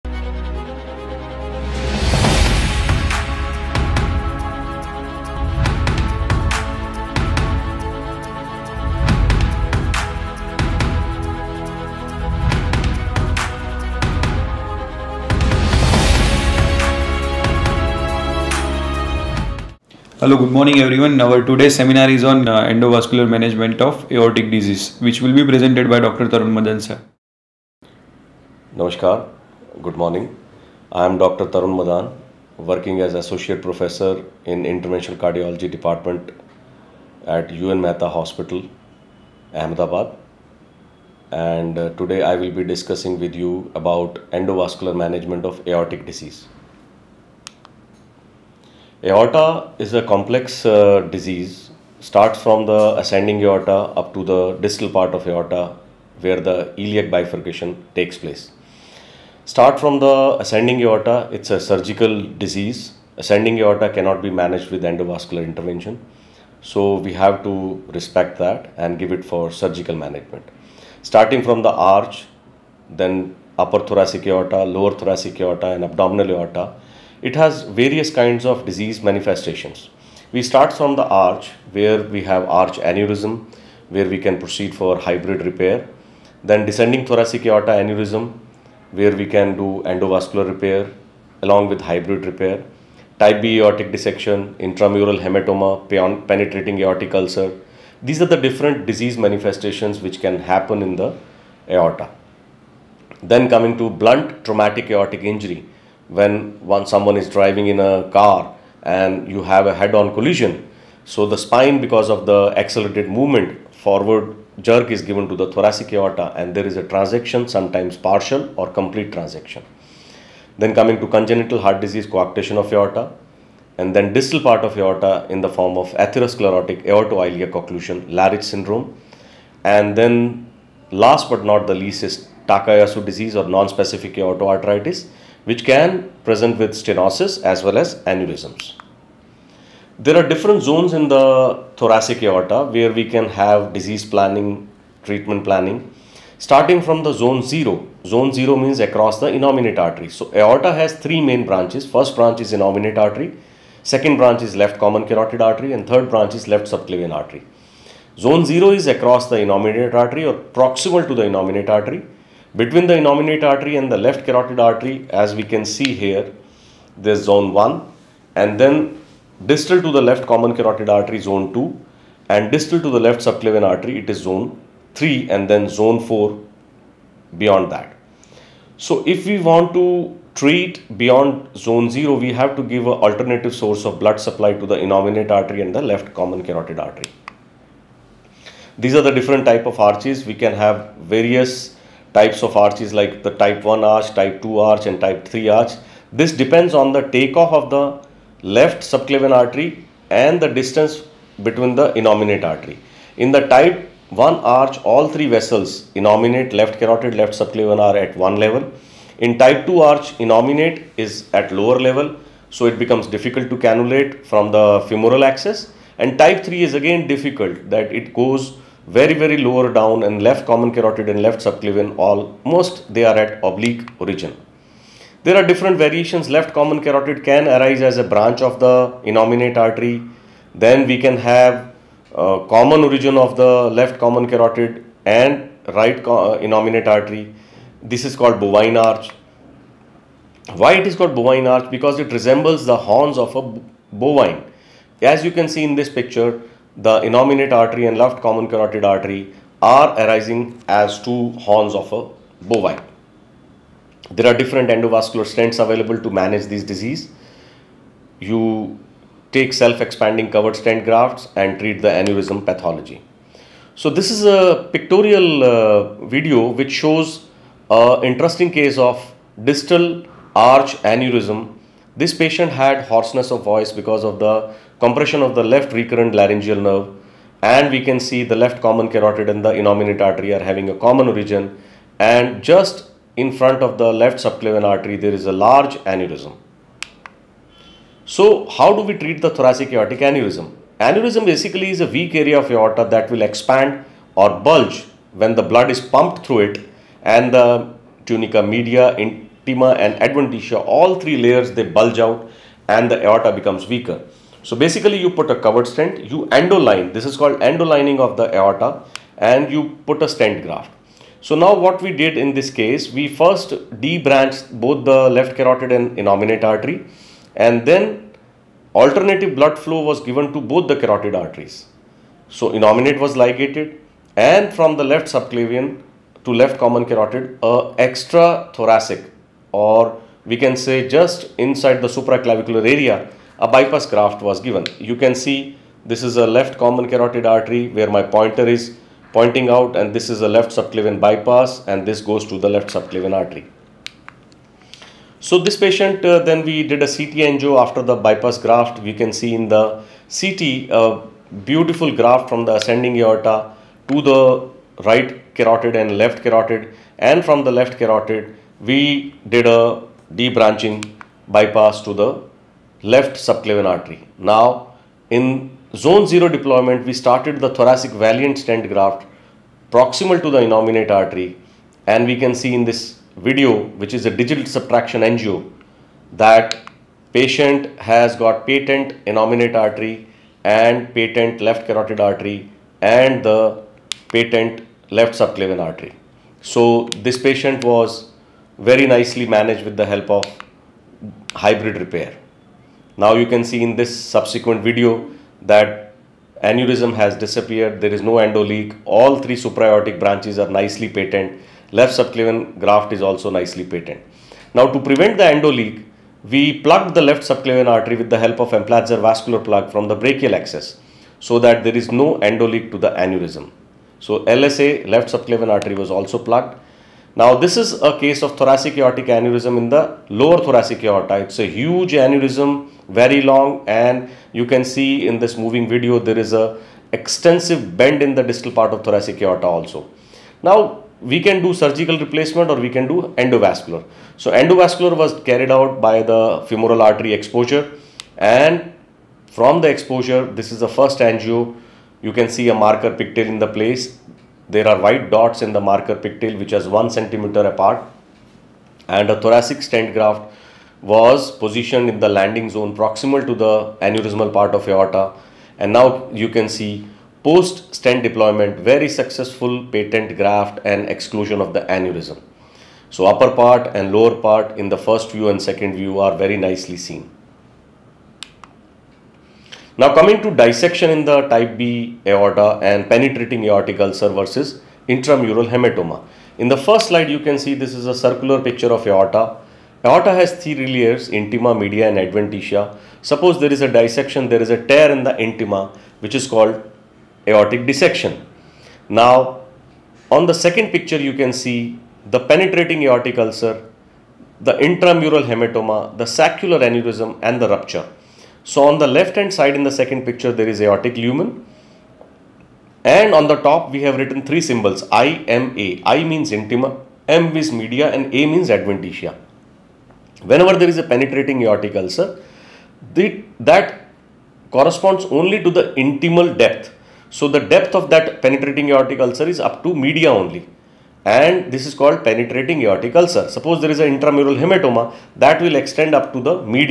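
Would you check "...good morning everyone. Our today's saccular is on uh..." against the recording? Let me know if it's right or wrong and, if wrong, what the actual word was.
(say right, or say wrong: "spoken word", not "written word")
wrong: "seminar", not "saccular".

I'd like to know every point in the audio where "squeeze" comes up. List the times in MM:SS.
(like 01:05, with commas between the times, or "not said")
not said.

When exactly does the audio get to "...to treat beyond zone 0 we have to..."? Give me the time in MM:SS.
02:59.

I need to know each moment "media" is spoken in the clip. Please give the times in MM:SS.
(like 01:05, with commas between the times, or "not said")
04:58, 08:01, 08:27, 08:39.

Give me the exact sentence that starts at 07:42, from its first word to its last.
So upper part and lower part in the first view and second view are very nicely seen.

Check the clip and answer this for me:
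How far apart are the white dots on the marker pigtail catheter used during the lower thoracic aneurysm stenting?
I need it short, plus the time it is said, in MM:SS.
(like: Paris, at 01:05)
1 centimeter, at 07:26.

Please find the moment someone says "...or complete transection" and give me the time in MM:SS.
01:58.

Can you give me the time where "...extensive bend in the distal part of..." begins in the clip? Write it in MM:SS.
07:06.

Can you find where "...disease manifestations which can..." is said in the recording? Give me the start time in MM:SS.
01:38.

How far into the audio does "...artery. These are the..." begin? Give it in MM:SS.
03:06.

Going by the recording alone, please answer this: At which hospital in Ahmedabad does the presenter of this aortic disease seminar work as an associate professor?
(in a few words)
UN Mehta Hospital.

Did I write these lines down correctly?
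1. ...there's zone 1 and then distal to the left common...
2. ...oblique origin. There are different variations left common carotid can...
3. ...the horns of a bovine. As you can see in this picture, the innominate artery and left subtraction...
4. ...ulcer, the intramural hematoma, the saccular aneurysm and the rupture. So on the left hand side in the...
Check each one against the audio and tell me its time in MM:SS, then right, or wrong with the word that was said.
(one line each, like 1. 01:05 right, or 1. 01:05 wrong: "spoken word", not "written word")
1. 02:46 right
2. 03:43 right
3. 04:02 wrong: "common", not "subtraction"
4. 08:13 right.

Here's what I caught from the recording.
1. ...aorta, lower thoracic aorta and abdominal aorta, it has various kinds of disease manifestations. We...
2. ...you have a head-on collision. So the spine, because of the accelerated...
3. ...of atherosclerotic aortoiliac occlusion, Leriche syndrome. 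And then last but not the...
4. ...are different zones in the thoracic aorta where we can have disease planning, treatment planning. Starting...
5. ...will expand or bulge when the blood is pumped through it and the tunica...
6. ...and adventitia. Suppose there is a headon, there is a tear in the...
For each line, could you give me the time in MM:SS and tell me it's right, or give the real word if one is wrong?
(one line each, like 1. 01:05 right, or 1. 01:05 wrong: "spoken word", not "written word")
1. 01:14 right
2. 01:49 right
3. 02:05 right
4. 02:20 right
5. 04:53 right
6. 08:01 wrong: "dissection", not "headon".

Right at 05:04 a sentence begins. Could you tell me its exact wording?
So basically you put a covered stent, you endoline, this is called endolining of the aorta and you put a stent graft.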